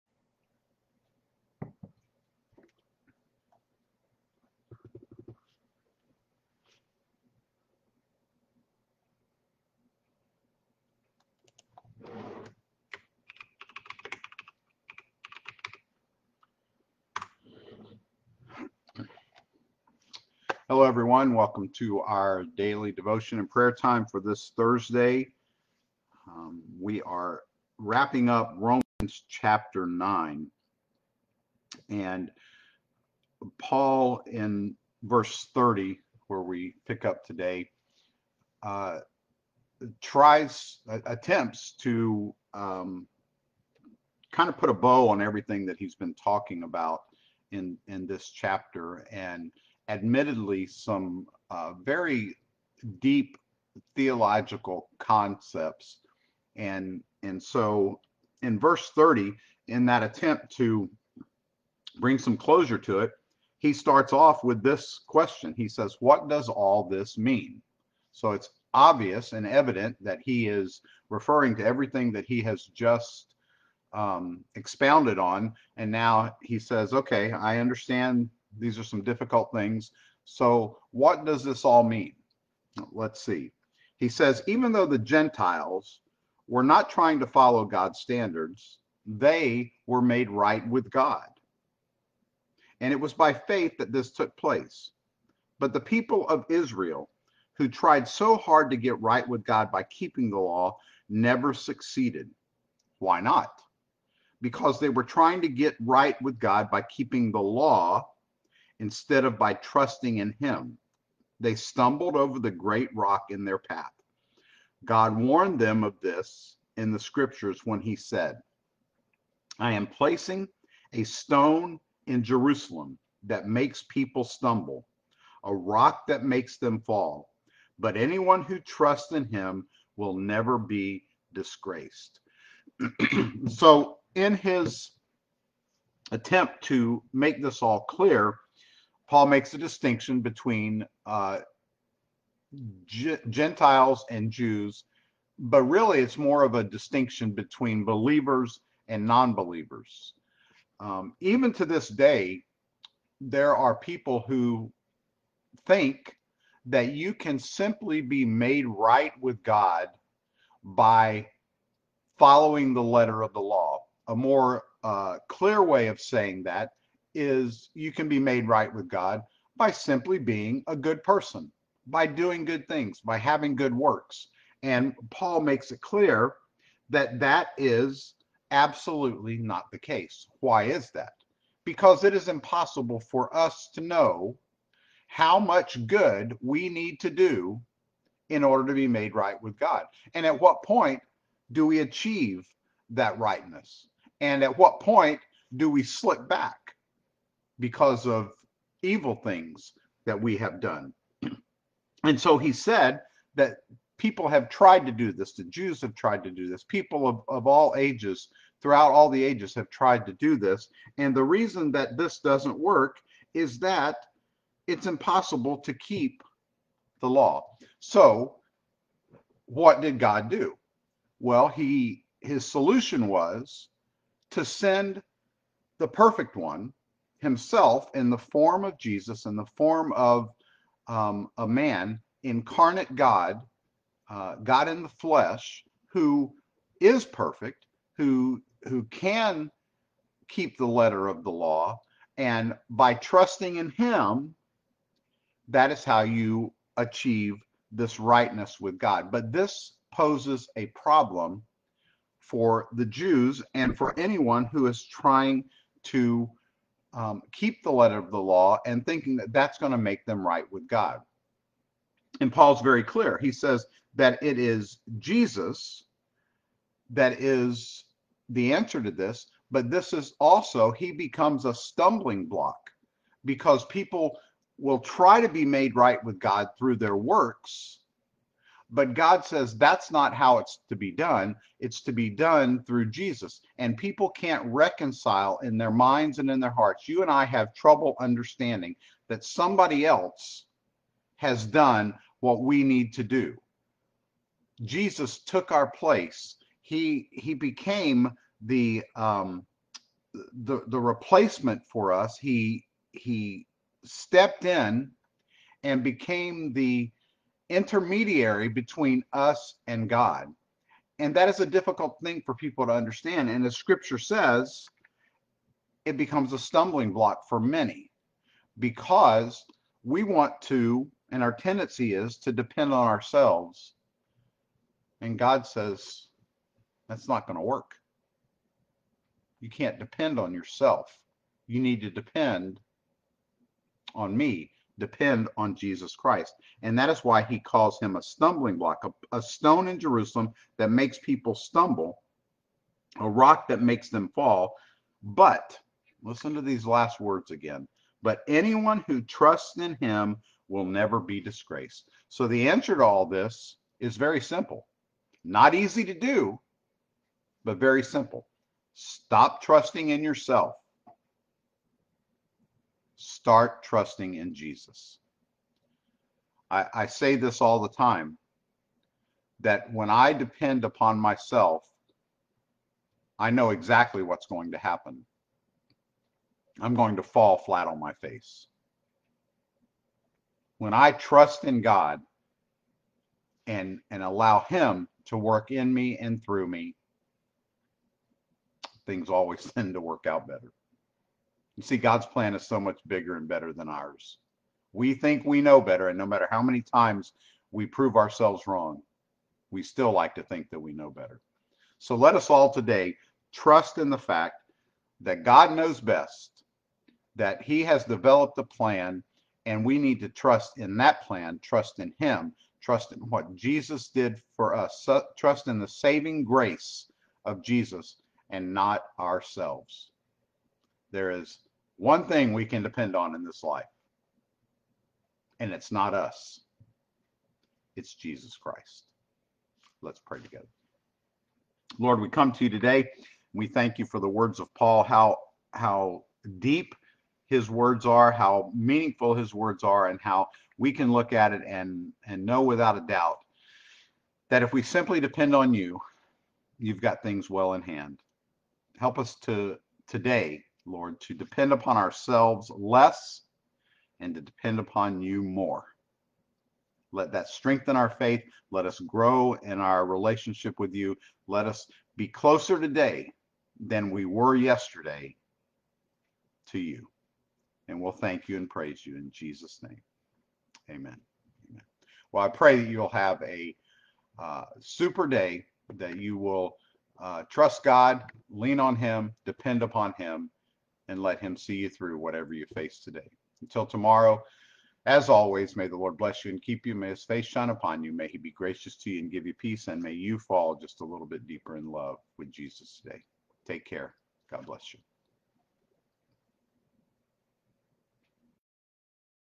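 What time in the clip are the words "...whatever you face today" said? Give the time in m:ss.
8:01.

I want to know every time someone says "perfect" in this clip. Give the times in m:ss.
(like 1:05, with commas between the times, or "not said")
3:45, 3:57.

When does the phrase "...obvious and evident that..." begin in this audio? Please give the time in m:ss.
1:08.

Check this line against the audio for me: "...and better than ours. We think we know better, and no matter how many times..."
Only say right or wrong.
right.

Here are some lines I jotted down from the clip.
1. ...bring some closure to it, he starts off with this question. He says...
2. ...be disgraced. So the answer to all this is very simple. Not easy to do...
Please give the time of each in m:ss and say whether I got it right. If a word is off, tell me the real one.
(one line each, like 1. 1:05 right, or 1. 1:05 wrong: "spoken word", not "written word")
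1. 1:01 right
2. 5:50 right.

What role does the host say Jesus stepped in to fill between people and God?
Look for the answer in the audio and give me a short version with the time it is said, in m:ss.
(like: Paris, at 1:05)
Intermediary, at 5:07.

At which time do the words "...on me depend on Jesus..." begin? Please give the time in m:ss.
5:33.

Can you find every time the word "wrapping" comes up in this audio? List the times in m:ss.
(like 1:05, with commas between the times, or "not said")
0:27.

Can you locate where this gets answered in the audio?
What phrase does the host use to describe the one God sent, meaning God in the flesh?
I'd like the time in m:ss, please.
3:52.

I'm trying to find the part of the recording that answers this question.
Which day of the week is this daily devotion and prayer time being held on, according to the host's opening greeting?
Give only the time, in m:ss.
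0:24.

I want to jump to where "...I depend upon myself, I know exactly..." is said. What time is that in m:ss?
6:09.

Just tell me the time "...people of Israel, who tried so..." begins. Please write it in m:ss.
1:35.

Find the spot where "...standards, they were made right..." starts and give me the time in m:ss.
1:27.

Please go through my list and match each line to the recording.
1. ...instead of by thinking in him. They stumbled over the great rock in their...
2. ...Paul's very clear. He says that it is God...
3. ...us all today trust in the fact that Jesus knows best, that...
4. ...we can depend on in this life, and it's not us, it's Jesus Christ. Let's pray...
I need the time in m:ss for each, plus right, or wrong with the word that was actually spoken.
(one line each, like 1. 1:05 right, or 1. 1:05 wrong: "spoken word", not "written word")
1. 1:48 wrong: "trusting", not "thinking"
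2. 4:22 wrong: "Jesus", not "God"
3. 6:42 wrong: "God", not "Jesus"
4. 7:02 right.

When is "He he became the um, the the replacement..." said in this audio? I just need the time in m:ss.
4:56.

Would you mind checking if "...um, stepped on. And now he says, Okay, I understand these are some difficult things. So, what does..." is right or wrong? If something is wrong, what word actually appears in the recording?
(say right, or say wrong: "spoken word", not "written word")
wrong: "expounded", not "stepped".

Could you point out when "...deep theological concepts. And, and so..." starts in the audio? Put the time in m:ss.
0:52.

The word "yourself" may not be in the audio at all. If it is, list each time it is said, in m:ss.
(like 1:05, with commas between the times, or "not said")
5:30, 6:00.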